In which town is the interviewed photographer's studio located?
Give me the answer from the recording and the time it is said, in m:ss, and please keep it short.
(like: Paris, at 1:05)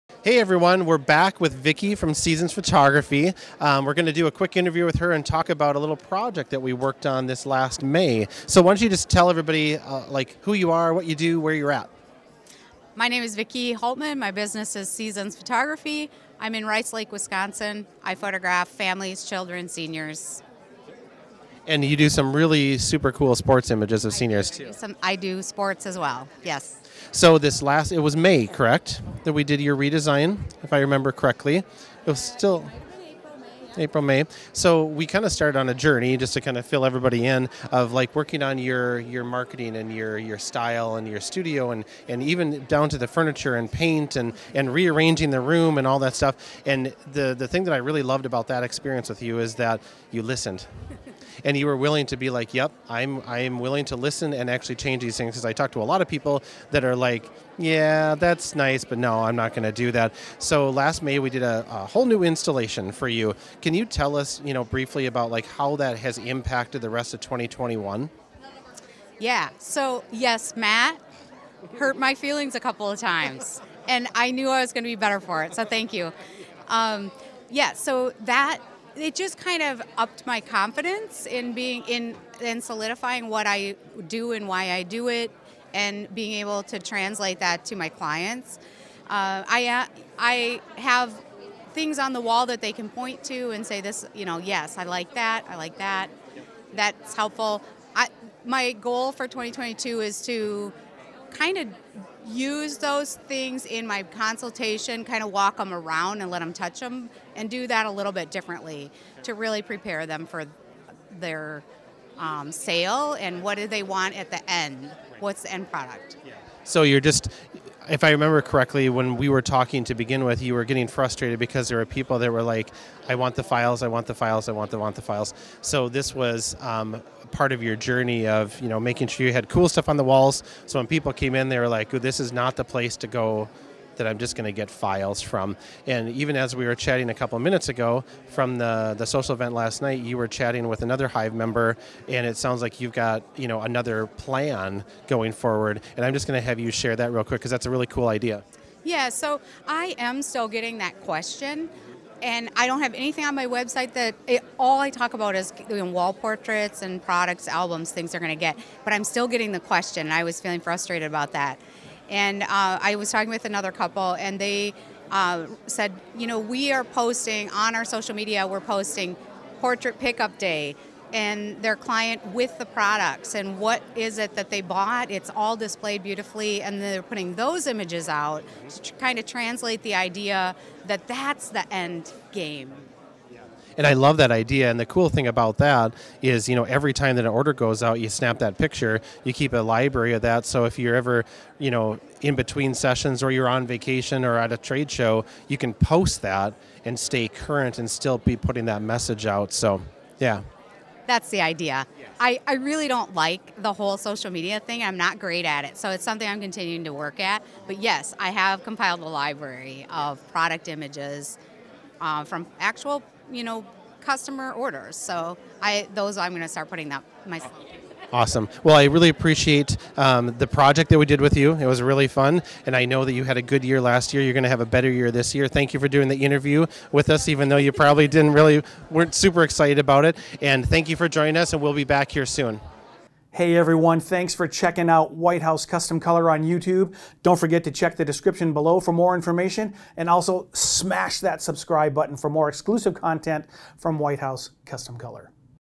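Rice Lake, Wisconsin, at 0:16.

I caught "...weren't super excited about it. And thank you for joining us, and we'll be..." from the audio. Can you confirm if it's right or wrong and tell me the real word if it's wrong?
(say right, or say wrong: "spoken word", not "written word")
right.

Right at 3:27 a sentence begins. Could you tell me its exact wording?
But yes, I have compiled a library of product images uh, from actual you know, customer orders.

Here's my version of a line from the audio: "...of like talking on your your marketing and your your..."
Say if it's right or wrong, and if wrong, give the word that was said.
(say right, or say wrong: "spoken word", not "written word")
wrong: "working", not "talking".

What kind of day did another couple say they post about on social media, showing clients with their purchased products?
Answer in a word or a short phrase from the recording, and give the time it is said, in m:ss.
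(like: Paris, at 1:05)
portrait pickup day, at 2:49.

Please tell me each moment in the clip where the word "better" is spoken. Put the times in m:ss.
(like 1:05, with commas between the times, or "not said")
1:14, 3:44.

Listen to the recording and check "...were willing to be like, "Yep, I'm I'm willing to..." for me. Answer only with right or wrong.
right.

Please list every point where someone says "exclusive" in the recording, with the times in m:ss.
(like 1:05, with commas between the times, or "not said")
4:02.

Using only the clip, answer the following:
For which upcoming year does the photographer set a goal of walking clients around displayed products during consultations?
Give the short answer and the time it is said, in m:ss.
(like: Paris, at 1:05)
2022, at 1:39.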